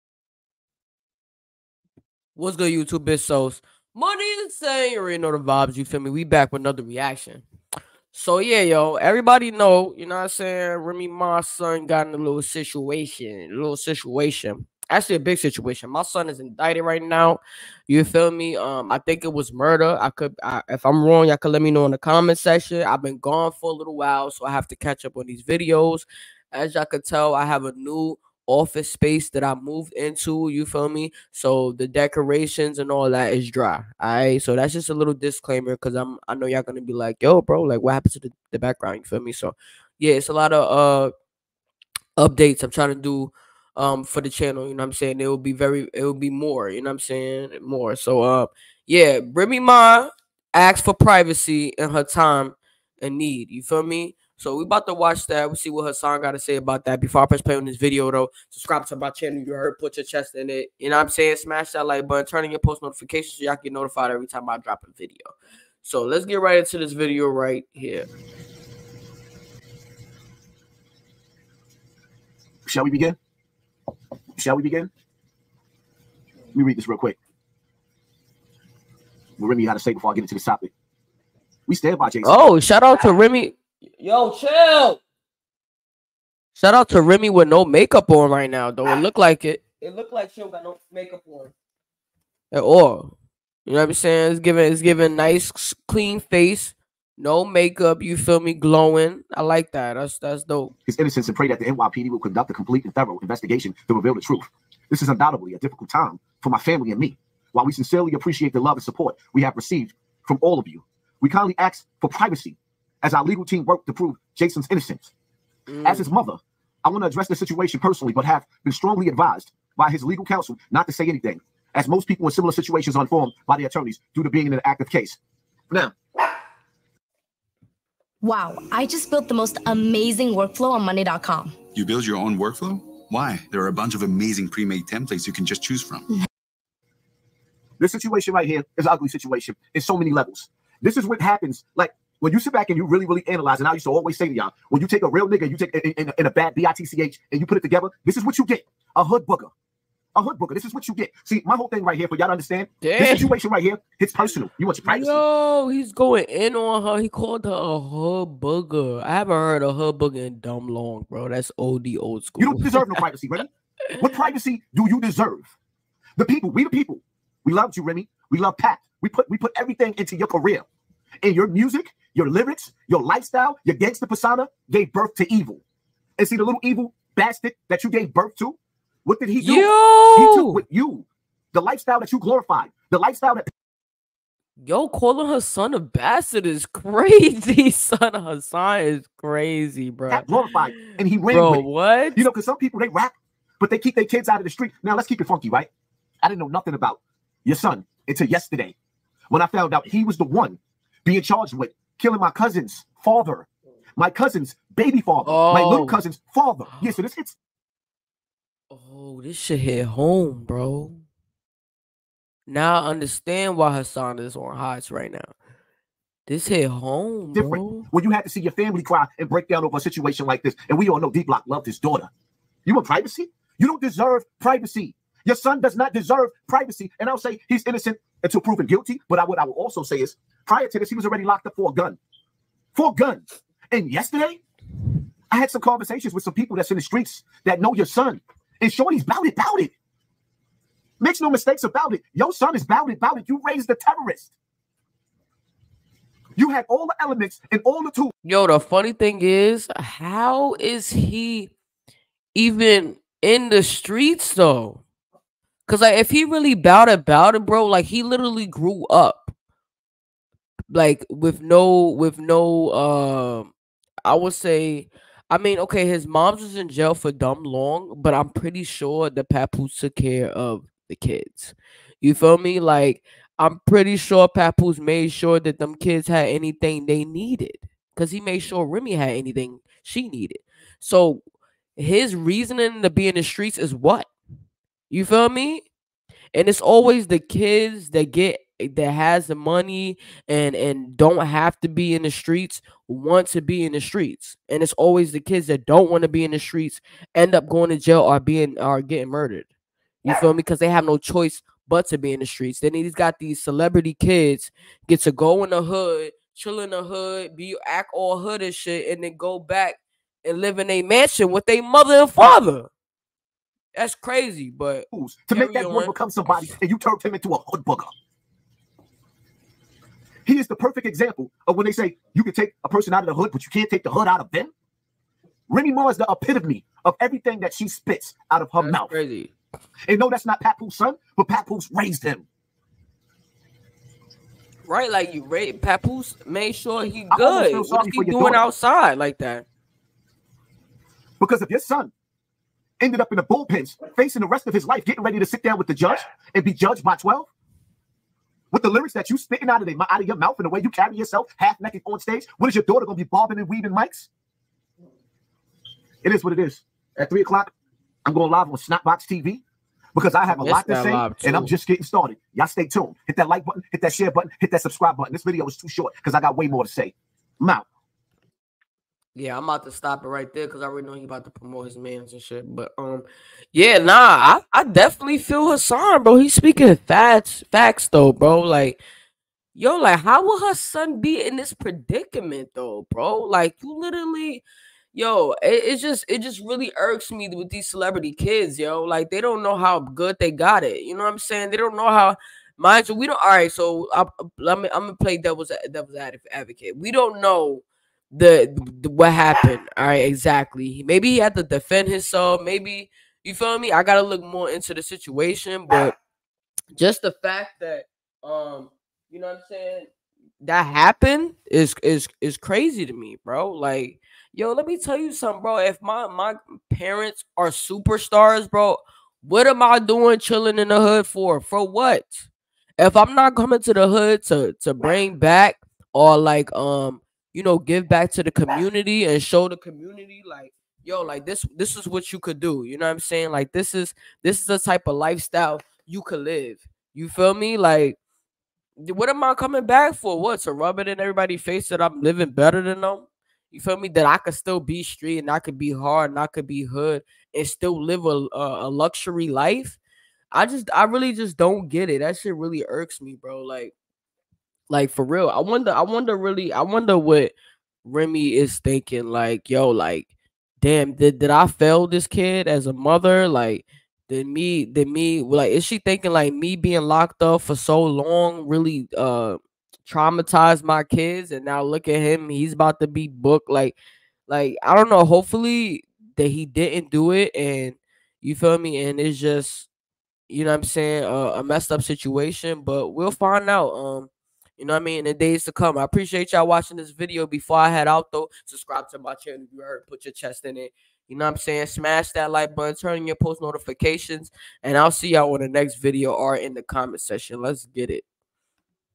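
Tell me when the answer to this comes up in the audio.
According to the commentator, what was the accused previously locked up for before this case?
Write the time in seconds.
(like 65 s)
232 s.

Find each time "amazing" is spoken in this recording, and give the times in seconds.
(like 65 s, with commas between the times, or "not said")
129 s, 134 s.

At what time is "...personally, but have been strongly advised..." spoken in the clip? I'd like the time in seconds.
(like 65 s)
117 s.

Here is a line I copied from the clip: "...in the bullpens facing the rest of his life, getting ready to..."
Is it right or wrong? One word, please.
right.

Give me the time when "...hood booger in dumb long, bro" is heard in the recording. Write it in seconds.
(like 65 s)
159 s.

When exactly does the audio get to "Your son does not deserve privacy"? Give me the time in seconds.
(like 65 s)
225 s.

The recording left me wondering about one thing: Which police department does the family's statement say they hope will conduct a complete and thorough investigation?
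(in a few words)
NYPD.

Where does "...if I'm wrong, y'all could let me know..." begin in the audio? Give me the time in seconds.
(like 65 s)
20 s.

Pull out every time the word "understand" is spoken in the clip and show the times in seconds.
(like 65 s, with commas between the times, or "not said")
152 s, 212 s.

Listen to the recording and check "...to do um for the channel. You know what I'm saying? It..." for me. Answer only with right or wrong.
right.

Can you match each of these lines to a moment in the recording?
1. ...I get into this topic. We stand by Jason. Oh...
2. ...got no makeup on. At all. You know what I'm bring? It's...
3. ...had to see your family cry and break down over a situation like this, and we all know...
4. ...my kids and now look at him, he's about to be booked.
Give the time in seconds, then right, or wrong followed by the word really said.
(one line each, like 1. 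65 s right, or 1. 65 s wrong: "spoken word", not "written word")
1. 80 s right
2. 90 s wrong: "saying", not "bring"
3. 218 s right
4. 470 s right.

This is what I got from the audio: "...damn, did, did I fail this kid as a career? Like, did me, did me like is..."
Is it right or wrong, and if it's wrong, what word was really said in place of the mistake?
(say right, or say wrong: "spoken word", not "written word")
wrong: "mother", not "career".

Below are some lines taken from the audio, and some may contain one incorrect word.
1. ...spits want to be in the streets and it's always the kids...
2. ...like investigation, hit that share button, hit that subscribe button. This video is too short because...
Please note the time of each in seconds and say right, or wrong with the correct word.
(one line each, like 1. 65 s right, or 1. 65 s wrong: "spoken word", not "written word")
1. 292 s wrong: "streets", not "spits"
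2. 363 s wrong: "button", not "investigation".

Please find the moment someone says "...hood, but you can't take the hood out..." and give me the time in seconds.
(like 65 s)
323 s.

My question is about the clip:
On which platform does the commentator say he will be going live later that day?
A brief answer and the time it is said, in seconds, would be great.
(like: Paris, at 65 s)
Snapbox TV, at 358 s.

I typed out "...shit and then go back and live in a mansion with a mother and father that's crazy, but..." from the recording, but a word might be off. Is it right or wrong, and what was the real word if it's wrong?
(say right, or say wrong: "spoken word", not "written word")
right.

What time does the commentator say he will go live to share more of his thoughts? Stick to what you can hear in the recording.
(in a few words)
3 o'clock.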